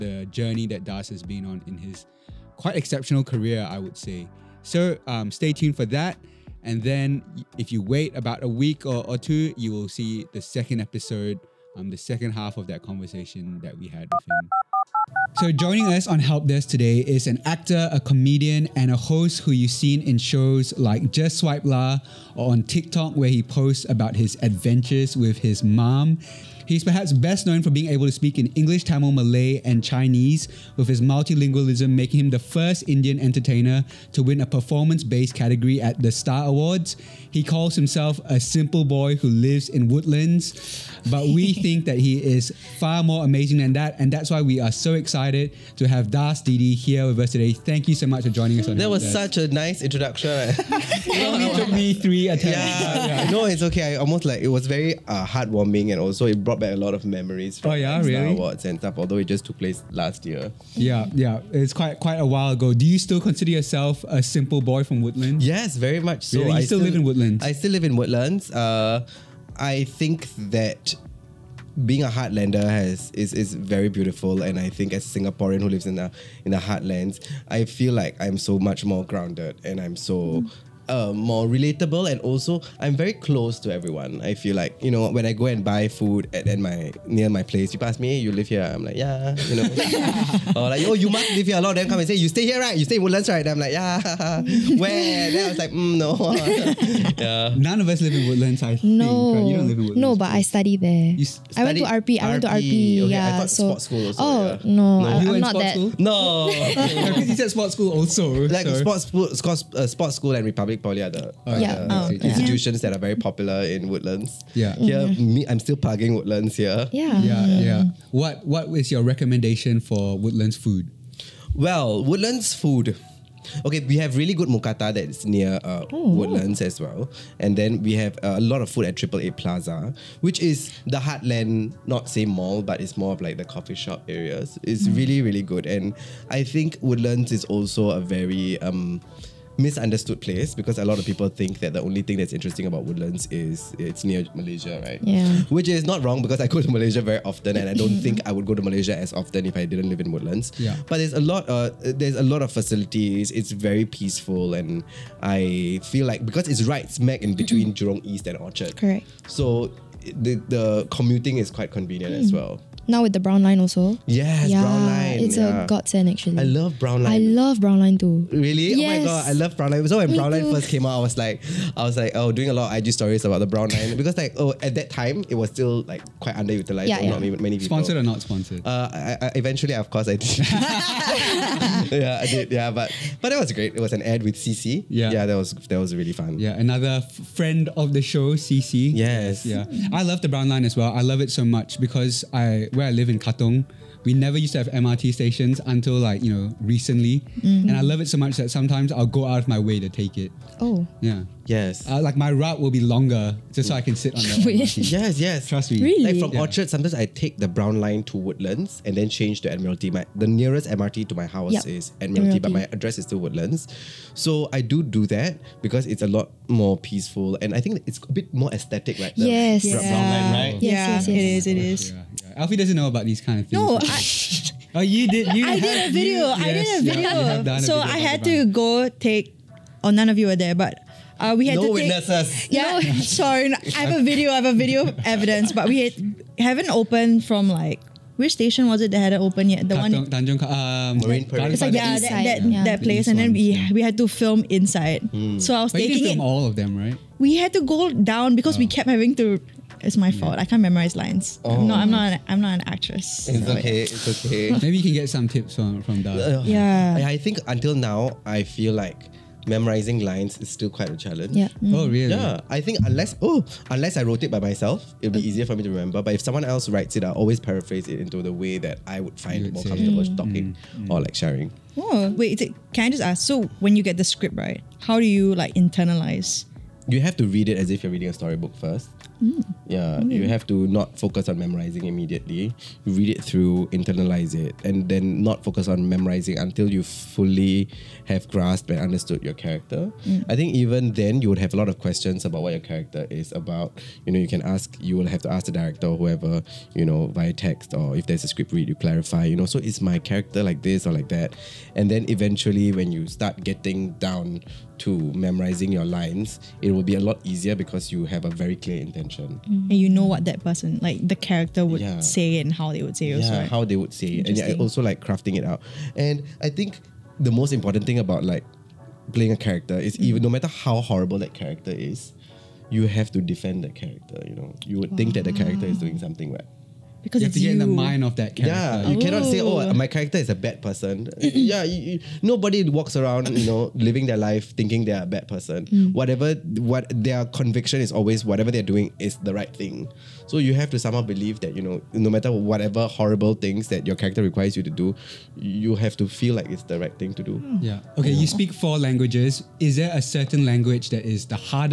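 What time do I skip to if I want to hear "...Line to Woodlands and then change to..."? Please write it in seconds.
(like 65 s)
207 s.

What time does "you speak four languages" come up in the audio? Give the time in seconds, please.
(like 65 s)
348 s.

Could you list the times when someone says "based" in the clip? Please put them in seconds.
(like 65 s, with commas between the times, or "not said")
35 s.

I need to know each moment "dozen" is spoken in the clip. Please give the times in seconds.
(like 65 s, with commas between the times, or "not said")
not said.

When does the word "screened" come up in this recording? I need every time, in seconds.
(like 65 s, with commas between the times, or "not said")
not said.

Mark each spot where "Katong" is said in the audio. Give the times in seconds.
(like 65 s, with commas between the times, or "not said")
193 s, 239 s.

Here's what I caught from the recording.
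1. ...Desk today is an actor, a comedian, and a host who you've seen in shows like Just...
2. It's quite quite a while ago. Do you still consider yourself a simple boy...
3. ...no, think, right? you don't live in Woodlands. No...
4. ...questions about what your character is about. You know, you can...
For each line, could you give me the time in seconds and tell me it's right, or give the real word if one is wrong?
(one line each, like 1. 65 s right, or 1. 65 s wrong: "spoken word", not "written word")
1. 16 s right
2. 61 s right
3. 98 s right
4. 291 s right.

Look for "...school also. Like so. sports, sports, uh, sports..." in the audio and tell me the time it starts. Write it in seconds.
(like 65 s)
107 s.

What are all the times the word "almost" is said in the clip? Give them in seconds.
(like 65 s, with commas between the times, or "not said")
53 s.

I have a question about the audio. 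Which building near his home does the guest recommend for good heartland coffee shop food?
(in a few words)
Triple A Plaza.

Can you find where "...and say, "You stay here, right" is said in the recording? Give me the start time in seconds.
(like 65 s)
91 s.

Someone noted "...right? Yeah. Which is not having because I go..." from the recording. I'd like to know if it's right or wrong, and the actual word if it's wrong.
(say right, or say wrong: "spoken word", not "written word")
wrong: "wrong", not "having".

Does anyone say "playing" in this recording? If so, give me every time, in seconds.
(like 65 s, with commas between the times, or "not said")
319 s.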